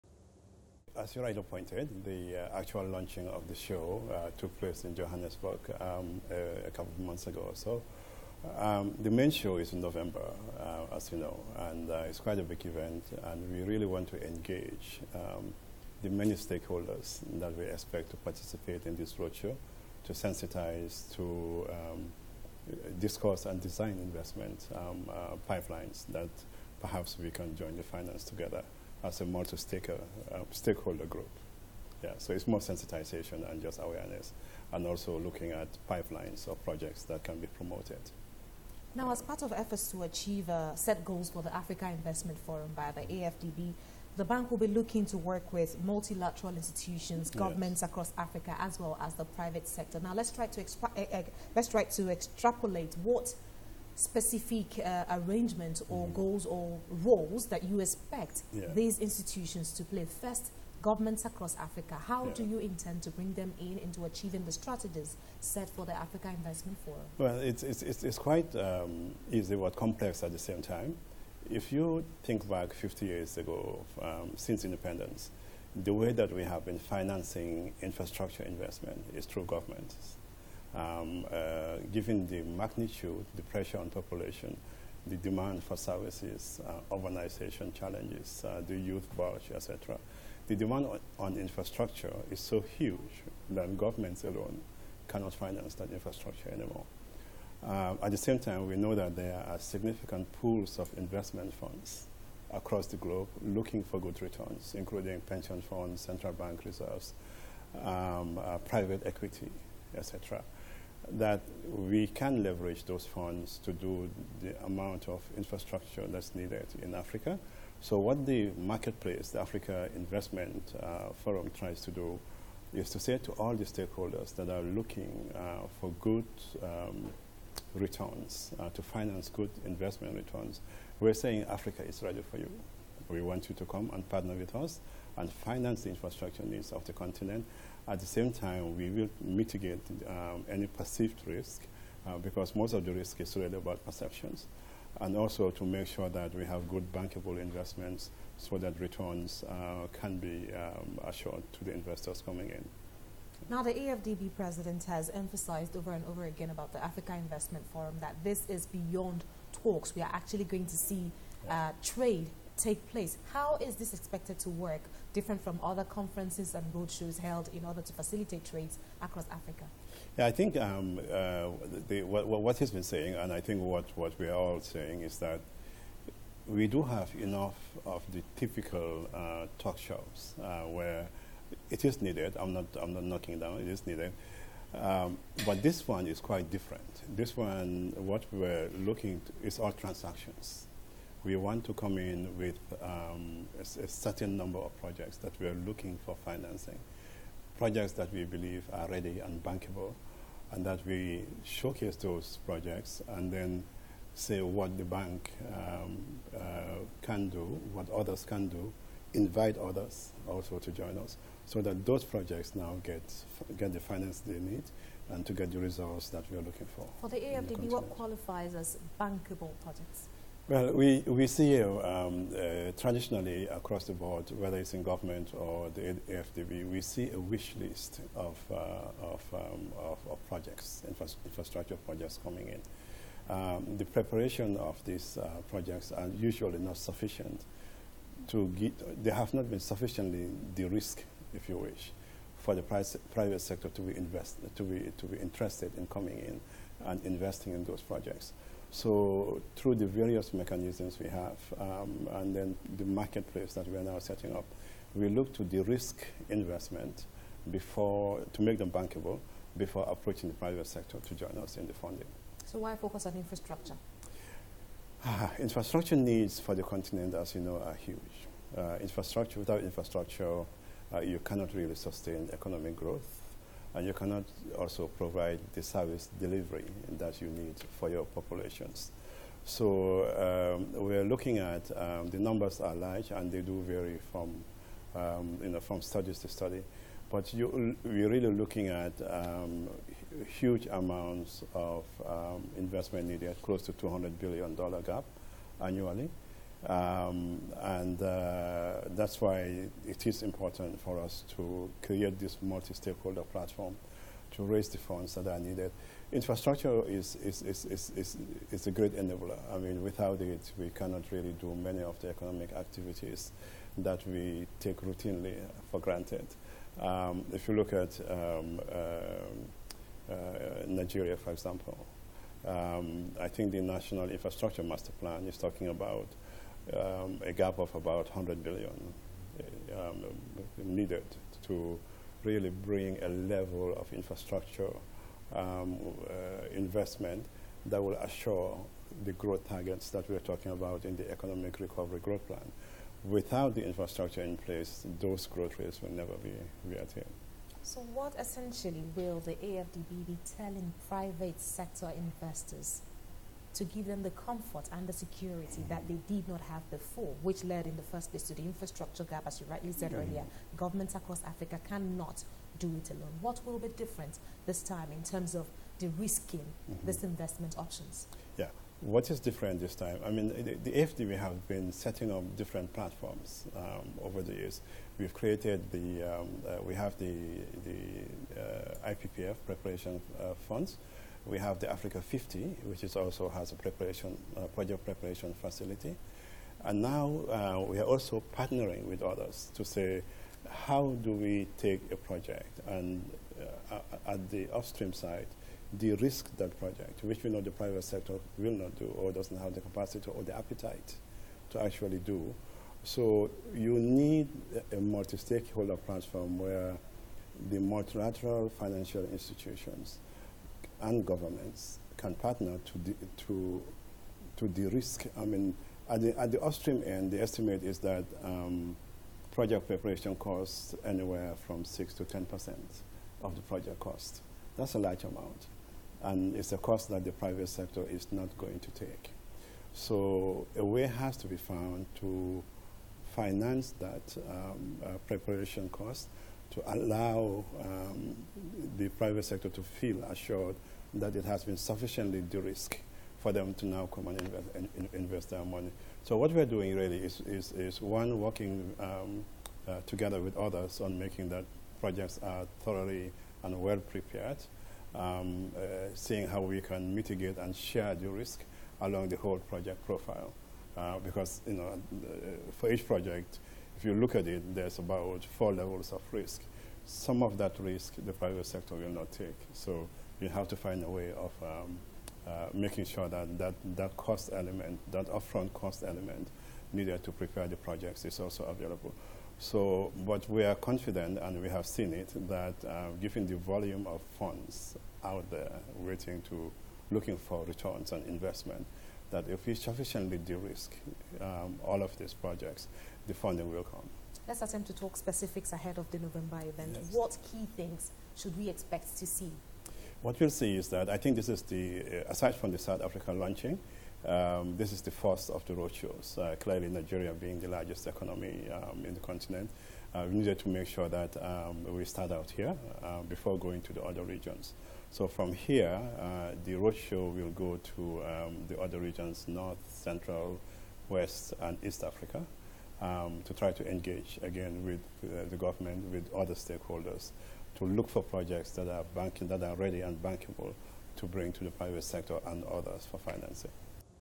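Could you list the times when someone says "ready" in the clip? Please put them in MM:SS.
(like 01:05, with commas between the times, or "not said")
02:12, 03:18, 08:49.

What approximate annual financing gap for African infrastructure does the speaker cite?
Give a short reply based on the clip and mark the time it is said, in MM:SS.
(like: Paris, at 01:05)
200 billion dollars, at 04:53.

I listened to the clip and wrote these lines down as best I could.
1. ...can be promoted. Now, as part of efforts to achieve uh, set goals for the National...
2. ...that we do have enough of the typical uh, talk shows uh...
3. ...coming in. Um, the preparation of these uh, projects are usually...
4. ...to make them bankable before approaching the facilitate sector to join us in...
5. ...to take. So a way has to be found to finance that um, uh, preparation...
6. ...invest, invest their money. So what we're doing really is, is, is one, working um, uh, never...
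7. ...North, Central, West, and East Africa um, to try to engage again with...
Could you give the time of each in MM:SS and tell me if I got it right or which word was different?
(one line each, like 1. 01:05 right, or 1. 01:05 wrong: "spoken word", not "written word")
1. 00:37 wrong: "Africa", not "National"
2. 02:55 right
3. 03:52 right
4. 04:18 wrong: "private", not "facilitate"
5. 07:08 right
6. 07:24 wrong: "together", not "never"
7. 08:39 right.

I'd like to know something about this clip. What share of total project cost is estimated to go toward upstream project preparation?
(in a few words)
6 to 10 percent.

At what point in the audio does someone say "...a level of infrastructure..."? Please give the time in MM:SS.
05:33.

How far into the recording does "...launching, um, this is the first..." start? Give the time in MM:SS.
08:23.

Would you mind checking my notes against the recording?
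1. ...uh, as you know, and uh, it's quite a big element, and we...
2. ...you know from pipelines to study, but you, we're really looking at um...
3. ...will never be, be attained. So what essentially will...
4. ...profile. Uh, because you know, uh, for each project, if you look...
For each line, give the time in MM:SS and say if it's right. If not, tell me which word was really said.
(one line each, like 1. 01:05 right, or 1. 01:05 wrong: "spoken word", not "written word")
1. 00:10 wrong: "event", not "element"
2. 04:45 wrong: "studies", not "pipelines"
3. 05:45 right
4. 07:39 right.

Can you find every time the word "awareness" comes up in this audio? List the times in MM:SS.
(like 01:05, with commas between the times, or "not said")
00:33.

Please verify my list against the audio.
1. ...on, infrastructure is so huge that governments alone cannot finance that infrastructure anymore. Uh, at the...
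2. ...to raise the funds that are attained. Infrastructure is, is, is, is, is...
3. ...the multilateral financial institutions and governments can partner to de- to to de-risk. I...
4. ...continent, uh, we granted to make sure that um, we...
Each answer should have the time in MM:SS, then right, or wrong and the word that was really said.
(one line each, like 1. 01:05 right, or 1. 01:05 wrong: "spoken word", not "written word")
1. 01:31 right
2. 05:04 wrong: "needed", not "attained"
3. 06:47 right
4. 08:28 wrong: "needed", not "granted".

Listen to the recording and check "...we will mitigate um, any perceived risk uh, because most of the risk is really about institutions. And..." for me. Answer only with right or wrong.
wrong.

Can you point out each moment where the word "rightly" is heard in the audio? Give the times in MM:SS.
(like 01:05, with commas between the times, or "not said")
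00:01, 05:59.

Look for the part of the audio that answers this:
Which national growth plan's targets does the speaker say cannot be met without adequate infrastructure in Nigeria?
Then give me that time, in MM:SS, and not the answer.
05:41.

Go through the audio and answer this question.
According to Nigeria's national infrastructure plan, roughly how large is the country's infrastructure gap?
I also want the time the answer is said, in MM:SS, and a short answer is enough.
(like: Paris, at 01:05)
100 billion, at 05:28.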